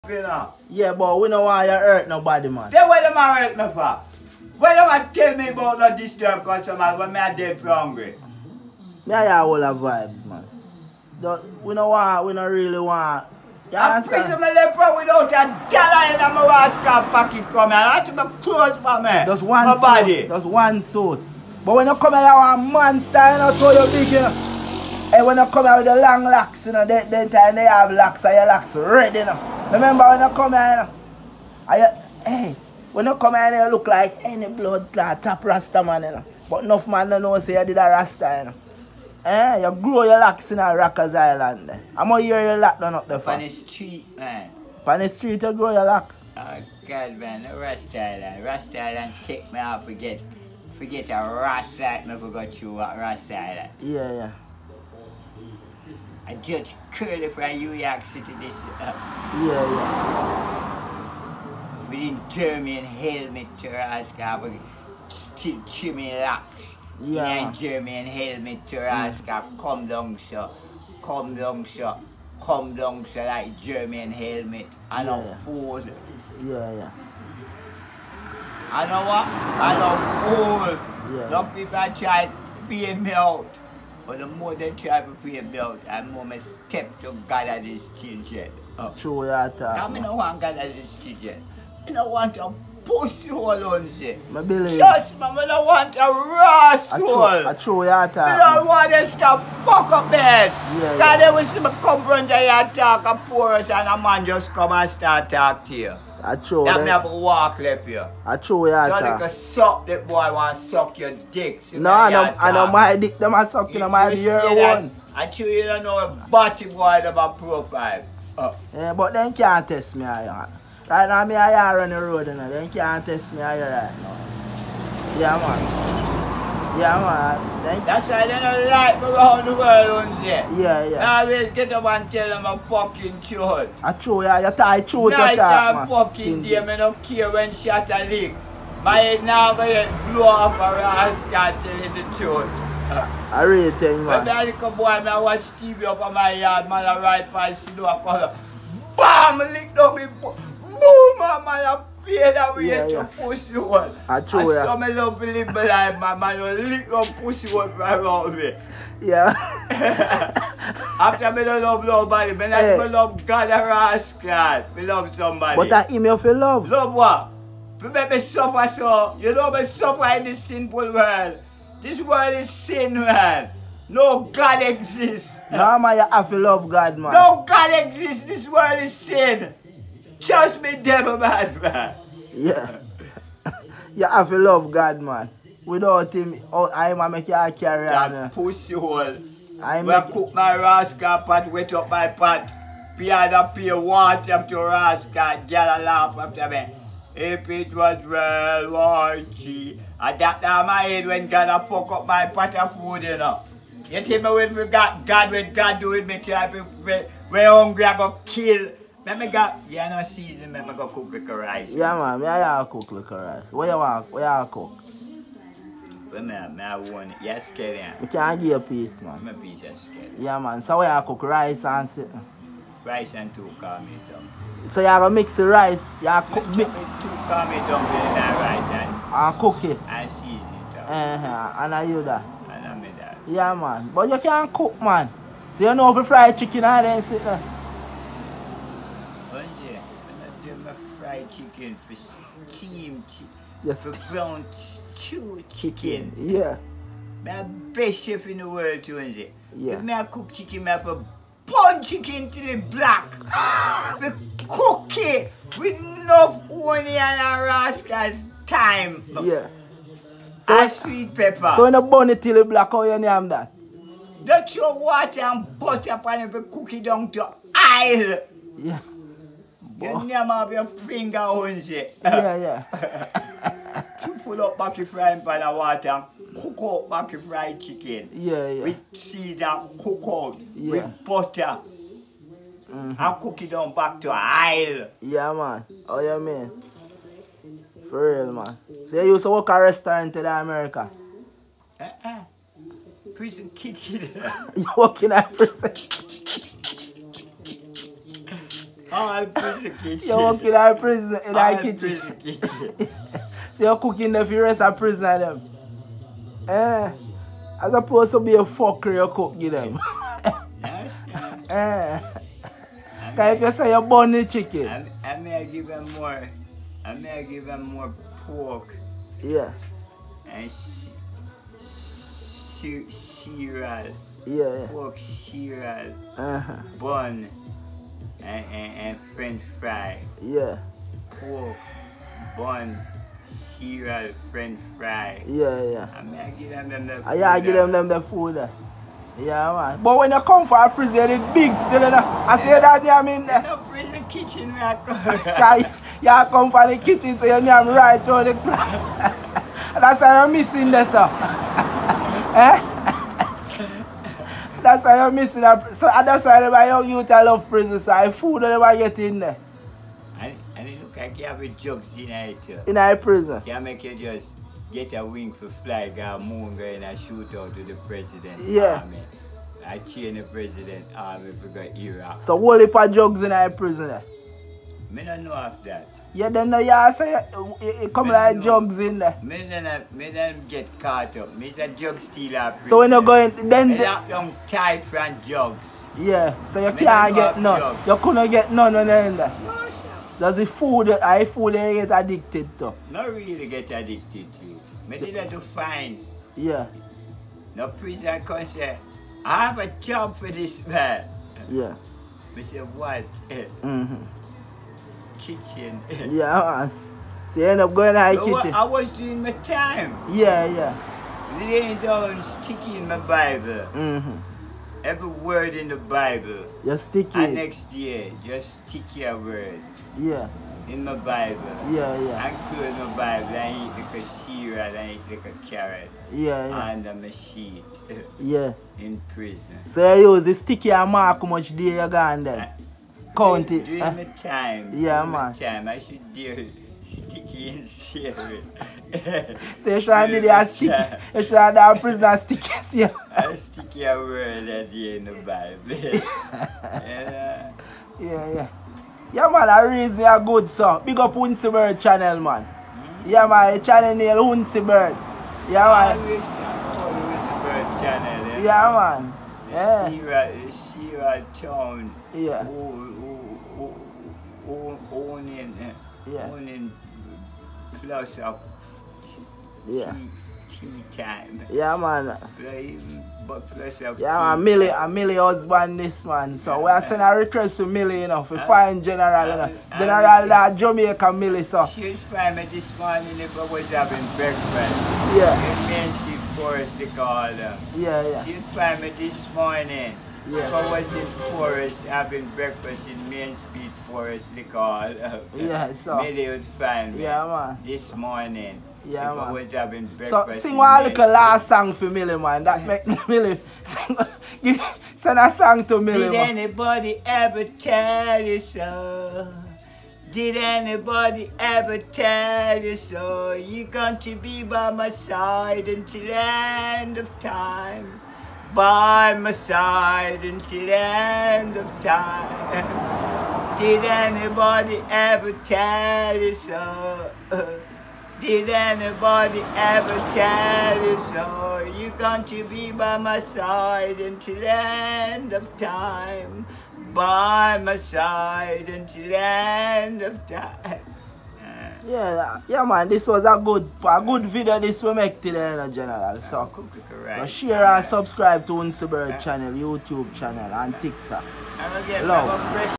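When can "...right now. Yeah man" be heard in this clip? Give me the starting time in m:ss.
2:03.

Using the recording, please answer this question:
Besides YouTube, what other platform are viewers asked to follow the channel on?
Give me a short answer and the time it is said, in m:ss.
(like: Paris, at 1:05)
TikTok, at 9:10.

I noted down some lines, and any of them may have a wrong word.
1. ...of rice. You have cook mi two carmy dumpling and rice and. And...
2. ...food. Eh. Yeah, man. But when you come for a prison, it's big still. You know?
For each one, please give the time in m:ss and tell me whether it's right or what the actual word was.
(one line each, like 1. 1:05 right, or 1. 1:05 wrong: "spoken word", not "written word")
1. 3:45 right
2. 5:38 right.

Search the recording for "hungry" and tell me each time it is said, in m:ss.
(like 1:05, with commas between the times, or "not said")
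0:07, 3:27.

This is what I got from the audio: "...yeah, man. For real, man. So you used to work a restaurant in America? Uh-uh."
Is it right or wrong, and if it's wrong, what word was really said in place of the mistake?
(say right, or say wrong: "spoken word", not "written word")
right.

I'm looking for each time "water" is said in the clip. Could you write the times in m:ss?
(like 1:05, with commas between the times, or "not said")
4:24, 4:35.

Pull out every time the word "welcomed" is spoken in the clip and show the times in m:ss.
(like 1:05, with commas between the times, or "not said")
not said.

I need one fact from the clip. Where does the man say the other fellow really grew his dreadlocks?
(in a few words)
Rikers Island.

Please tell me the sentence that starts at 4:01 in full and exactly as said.
fried chicken, for steam, chicken, yes.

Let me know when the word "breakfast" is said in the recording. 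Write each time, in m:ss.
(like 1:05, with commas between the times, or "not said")
8:04, 8:12, 8:19.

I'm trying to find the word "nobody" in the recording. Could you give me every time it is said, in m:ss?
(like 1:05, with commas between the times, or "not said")
0:02, 2:41.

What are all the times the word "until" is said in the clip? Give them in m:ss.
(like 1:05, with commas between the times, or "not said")
8:35, 8:40, 8:53, 8:58.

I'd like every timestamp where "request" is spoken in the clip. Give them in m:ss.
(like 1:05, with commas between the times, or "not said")
7:57.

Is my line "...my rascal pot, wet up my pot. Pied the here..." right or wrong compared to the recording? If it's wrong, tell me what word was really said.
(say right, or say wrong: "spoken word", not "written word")
right.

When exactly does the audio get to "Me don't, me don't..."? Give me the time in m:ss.
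6:19.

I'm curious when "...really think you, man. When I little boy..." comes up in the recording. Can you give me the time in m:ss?
2:23.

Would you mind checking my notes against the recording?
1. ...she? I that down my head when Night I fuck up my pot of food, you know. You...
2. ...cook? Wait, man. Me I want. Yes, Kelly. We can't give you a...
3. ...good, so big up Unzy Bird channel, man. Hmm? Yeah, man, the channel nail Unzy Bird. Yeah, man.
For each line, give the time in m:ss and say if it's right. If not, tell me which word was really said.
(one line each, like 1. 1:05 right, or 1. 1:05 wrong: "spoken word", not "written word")
1. 3:19 wrong: "God", not "Night"
2. 3:34 right
3. 7:30 right.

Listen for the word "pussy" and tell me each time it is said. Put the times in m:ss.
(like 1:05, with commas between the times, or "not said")
1:32, 2:33, 2:37, 3:08.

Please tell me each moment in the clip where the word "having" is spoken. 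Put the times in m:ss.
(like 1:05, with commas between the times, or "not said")
8:03, 8:11, 8:19.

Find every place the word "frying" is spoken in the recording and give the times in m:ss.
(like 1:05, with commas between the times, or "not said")
4:34.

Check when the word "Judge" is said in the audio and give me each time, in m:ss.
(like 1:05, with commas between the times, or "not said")
0:56.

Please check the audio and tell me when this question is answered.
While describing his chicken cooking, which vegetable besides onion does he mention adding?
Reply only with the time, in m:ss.
4:20.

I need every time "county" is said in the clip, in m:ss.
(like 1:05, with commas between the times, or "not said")
7:13.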